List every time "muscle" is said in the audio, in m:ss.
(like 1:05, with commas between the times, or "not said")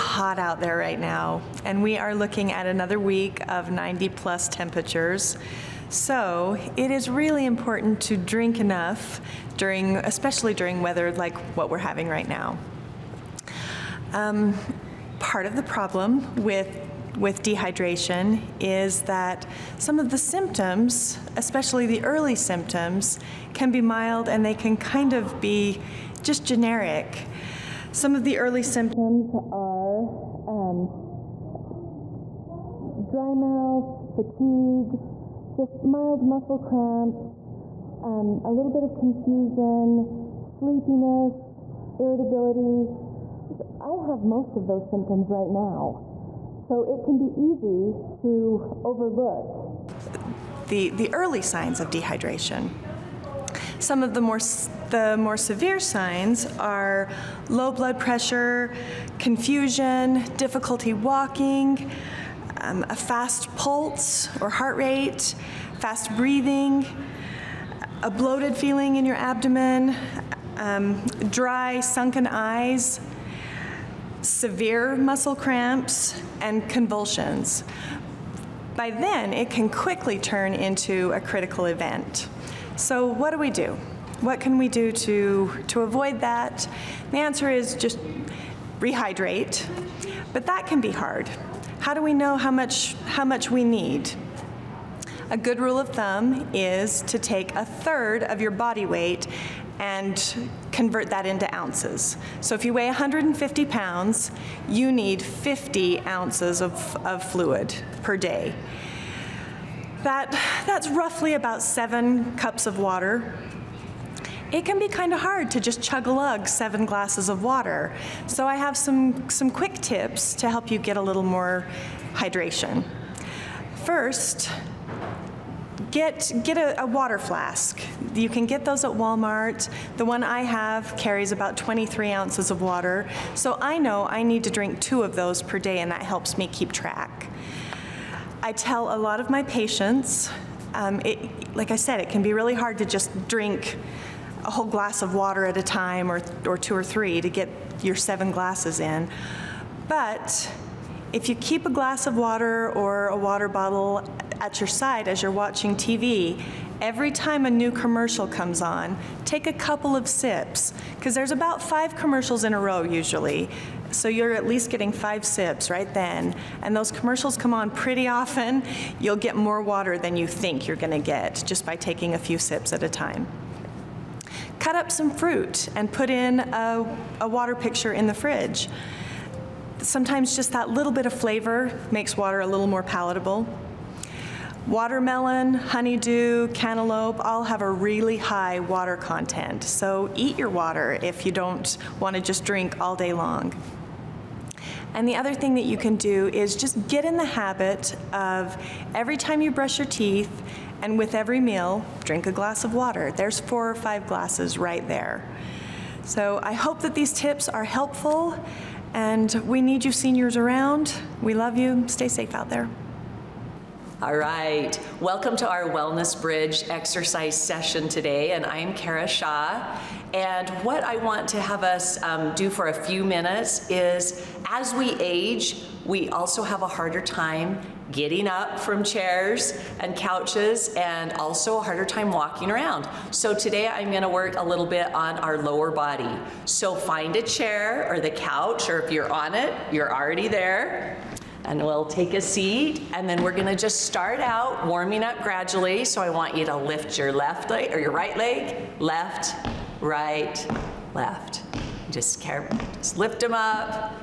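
0:36, 1:14.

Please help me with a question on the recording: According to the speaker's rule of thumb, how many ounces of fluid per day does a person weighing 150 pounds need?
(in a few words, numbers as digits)
50 ounces.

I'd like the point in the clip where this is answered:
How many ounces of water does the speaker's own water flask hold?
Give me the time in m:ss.
2:11.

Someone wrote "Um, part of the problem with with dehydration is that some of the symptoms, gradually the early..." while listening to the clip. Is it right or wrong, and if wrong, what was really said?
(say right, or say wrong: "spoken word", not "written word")
wrong: "especially", not "gradually".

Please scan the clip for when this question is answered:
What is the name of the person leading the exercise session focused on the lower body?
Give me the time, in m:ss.
3:38.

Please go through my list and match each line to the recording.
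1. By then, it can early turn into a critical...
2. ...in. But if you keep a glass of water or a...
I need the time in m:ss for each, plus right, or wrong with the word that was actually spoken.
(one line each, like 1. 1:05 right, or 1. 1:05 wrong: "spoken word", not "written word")
1. 1:18 wrong: "quickly", not "early"
2. 2:28 right.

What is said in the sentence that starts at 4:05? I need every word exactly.
So I want you to lift your left leg or your right leg, left, right, left.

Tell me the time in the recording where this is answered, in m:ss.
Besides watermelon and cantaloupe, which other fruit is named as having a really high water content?
3:05.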